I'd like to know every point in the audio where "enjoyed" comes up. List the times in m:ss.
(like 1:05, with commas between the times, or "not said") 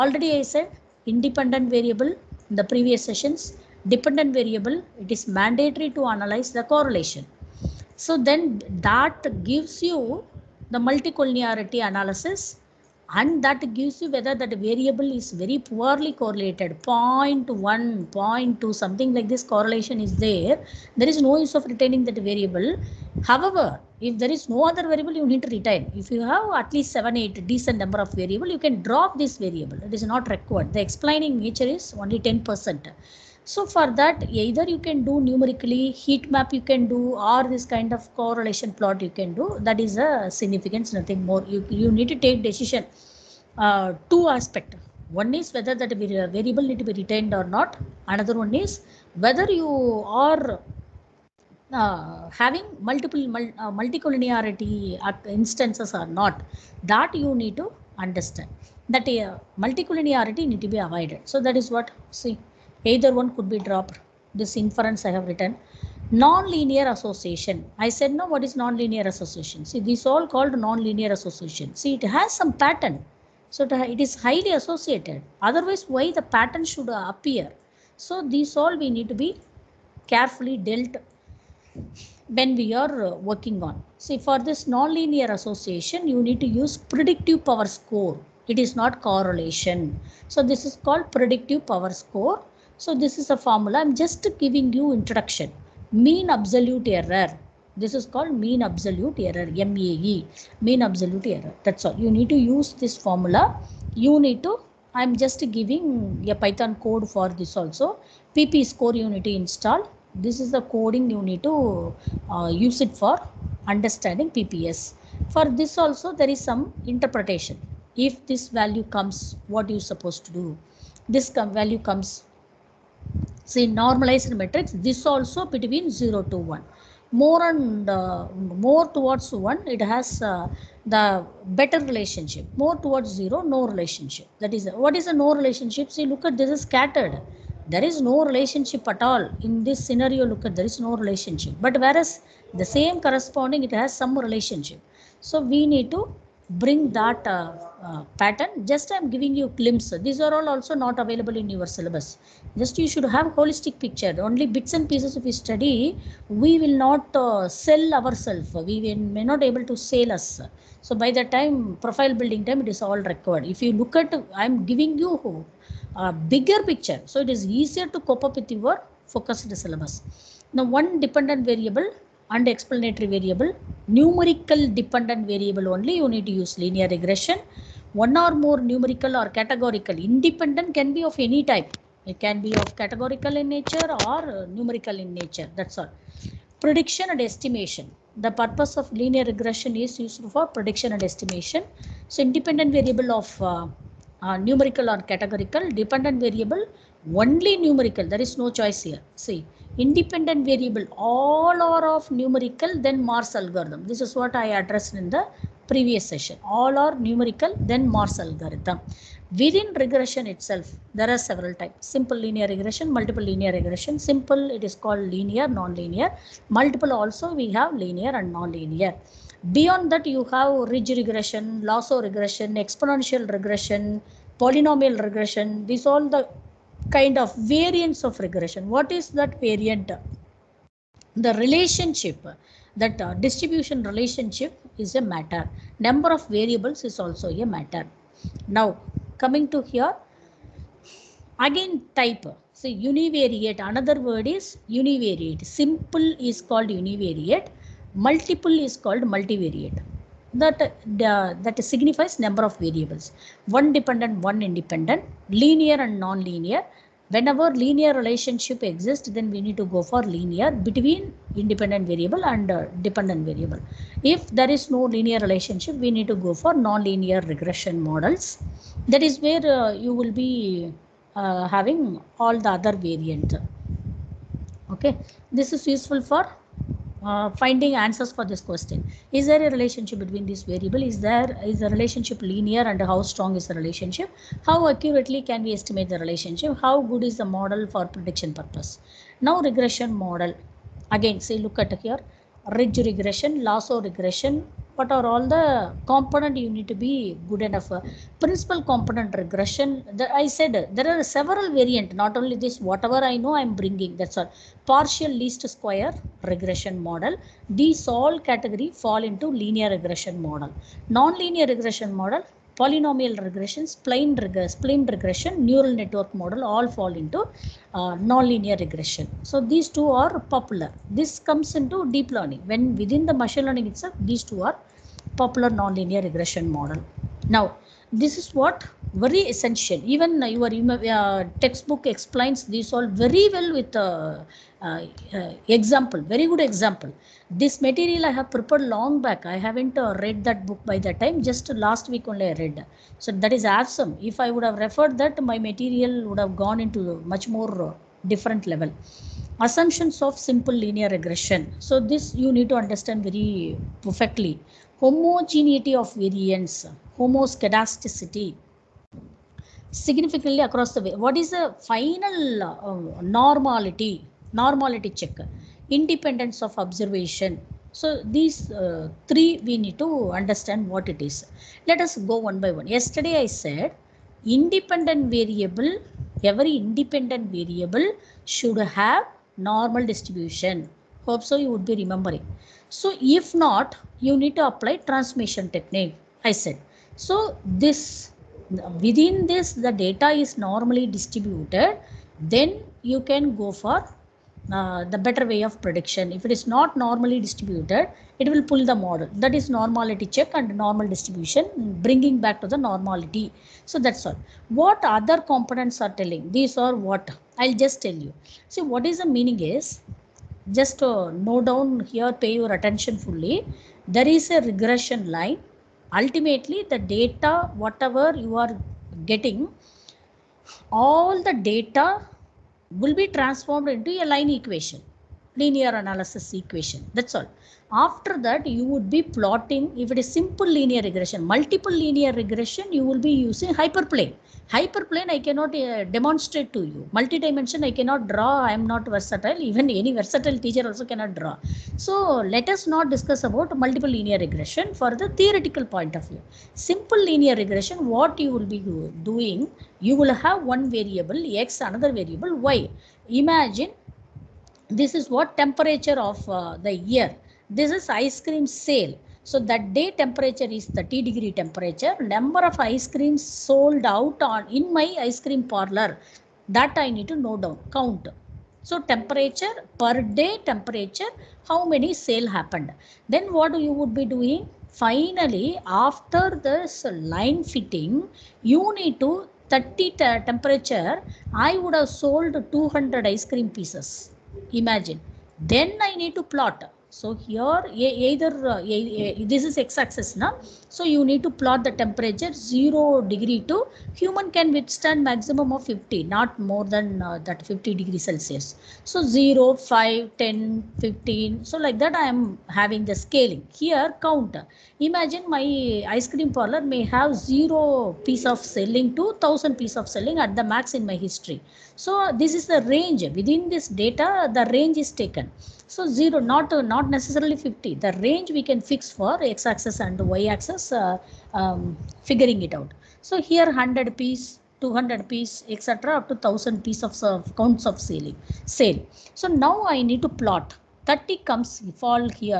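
not said.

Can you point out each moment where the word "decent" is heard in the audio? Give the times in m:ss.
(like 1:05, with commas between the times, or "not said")
0:27.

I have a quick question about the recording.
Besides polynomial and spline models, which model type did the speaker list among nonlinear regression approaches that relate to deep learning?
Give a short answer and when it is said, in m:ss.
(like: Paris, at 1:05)
neural network model, at 5:15.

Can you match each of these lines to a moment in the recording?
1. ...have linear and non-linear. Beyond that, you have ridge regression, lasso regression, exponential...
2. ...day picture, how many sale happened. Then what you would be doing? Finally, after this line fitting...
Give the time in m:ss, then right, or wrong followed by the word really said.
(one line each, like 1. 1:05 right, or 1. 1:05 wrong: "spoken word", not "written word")
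1. 3:37 right
2. 7:50 wrong: "temperature", not "picture".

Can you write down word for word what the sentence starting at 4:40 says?
Is there is the relationship linear and how strong is the relationship?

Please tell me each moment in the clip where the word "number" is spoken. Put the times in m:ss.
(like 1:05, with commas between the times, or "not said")
0:27, 3:55, 4:12, 7:42.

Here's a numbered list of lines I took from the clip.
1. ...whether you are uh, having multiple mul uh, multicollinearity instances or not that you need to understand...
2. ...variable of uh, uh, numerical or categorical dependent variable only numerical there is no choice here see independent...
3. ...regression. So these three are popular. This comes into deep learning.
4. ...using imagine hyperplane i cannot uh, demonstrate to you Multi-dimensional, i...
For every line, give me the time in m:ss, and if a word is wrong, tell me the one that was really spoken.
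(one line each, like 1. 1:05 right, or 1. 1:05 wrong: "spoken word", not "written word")
1. 0:49 right
2. 3:12 right
3. 5:18 wrong: "two", not "three"
4. 7:13 wrong: "hyperplane", not "imagine".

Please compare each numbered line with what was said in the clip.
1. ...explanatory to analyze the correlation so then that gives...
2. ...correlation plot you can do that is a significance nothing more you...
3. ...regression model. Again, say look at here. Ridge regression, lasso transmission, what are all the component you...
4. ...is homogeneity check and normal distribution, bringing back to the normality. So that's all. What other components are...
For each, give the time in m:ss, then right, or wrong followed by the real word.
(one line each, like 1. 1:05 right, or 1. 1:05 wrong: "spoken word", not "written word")
1. 0:05 wrong: "mandatory", not "explanatory"
2. 0:38 right
3. 4:49 wrong: "regression", not "transmission"
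4. 6:39 wrong: "normality", not "homogeneity".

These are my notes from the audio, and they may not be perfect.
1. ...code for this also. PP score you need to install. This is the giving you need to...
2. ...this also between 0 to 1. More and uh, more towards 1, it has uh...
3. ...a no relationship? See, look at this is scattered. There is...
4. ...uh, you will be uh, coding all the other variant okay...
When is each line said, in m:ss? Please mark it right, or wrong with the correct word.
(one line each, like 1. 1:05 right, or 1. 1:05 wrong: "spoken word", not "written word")
1. 1:46 wrong: "coding", not "giving"
2. 2:04 right
3. 2:15 right
4. 4:29 wrong: "having", not "coding".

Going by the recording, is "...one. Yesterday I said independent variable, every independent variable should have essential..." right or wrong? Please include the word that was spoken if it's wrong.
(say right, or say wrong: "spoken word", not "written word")
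wrong: "normal", not "essential".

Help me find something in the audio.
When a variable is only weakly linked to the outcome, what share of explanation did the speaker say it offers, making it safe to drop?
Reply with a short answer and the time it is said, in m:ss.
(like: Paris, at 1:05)
10 percent, at 0:32.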